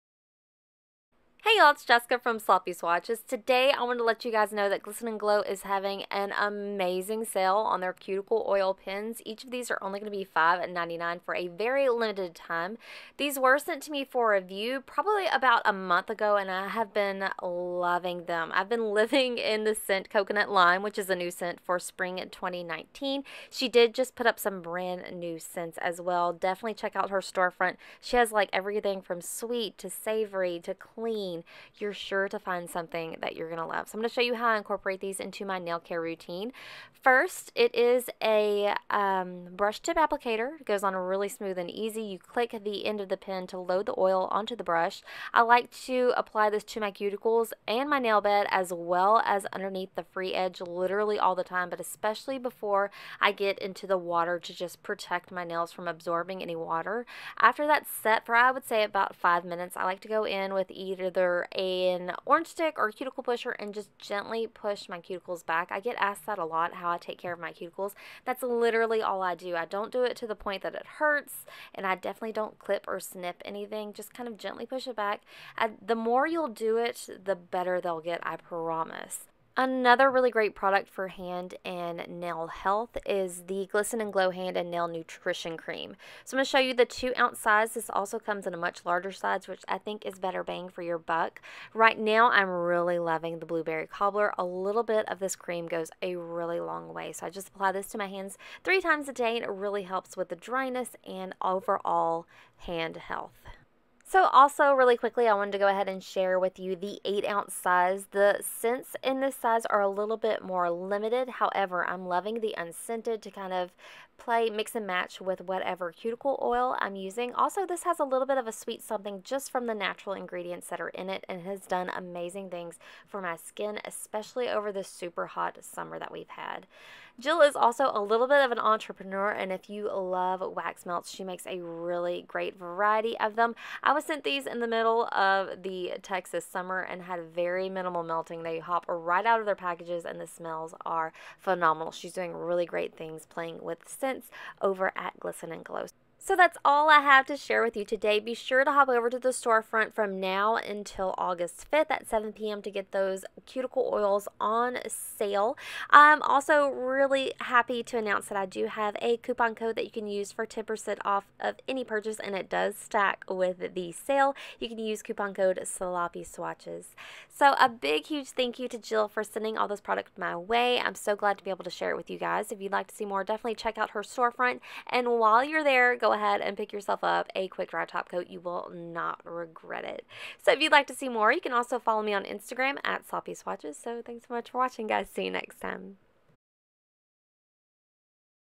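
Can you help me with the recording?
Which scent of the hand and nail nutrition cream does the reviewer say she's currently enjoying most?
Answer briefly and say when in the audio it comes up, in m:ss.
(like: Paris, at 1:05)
Blueberry Cobbler, at 1:33.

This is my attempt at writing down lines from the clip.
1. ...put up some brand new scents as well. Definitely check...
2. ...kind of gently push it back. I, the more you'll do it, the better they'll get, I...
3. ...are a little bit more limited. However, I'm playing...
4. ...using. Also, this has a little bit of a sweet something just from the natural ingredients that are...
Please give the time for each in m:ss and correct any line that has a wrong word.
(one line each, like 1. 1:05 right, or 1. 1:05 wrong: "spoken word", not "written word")
1. 0:24 right
2. 1:14 right
3. 1:49 wrong: "loving", not "playing"
4. 1:56 right.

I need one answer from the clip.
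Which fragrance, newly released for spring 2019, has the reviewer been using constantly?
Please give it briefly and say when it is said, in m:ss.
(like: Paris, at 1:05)
Coconut Lime, at 0:20.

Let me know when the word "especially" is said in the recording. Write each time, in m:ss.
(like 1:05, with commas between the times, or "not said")
0:51, 2:03.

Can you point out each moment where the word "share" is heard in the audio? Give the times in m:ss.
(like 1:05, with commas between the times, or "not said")
1:46, 2:27, 2:51.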